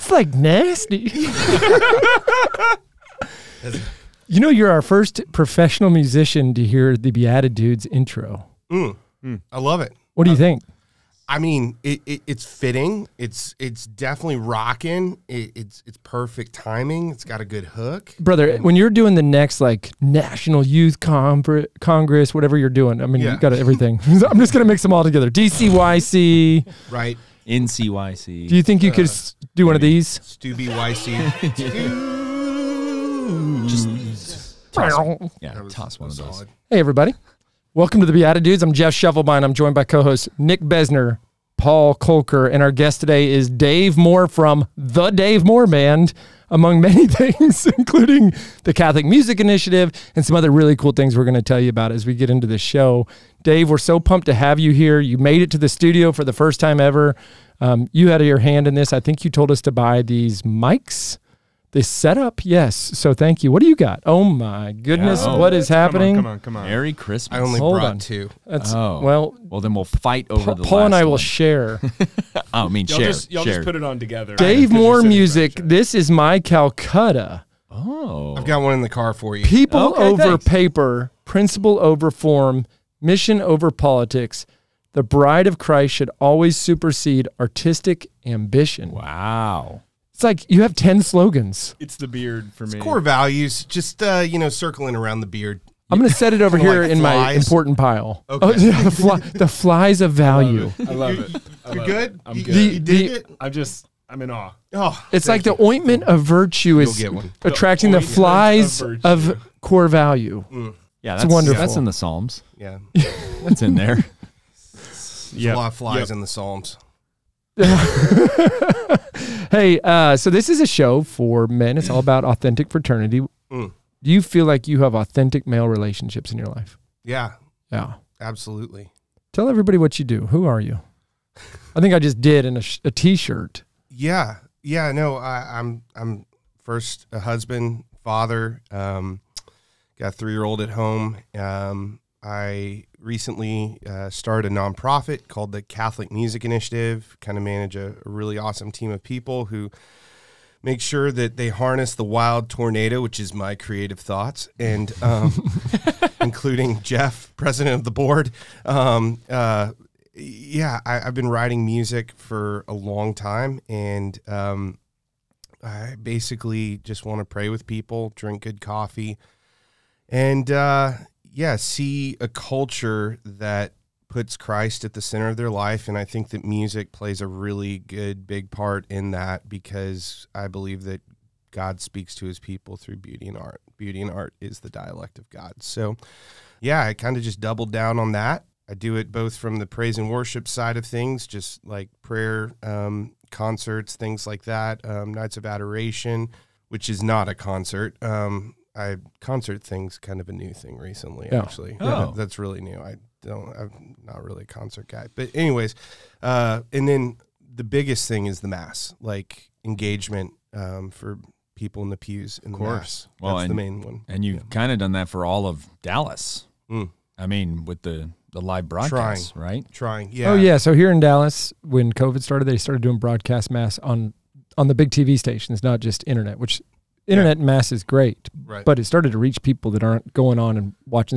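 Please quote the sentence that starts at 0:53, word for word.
Dave, we're so pumped to have you here.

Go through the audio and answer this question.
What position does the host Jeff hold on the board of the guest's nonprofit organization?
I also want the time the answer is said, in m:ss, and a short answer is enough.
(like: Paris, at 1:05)
president, at 2:37.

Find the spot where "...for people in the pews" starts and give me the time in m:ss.
3:30.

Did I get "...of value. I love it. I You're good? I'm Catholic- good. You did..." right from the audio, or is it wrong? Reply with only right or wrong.
wrong.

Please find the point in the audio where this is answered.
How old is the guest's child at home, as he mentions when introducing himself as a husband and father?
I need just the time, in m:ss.
2:20.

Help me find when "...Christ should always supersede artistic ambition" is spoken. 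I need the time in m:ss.
1:25.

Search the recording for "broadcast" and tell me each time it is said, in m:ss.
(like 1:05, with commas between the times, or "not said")
3:38, 3:42.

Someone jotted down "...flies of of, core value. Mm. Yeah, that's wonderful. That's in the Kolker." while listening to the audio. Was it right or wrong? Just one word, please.
wrong.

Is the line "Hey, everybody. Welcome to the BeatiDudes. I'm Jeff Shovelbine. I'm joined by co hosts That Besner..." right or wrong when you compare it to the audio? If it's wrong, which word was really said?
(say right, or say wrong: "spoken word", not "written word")
wrong: "Nick", not "That".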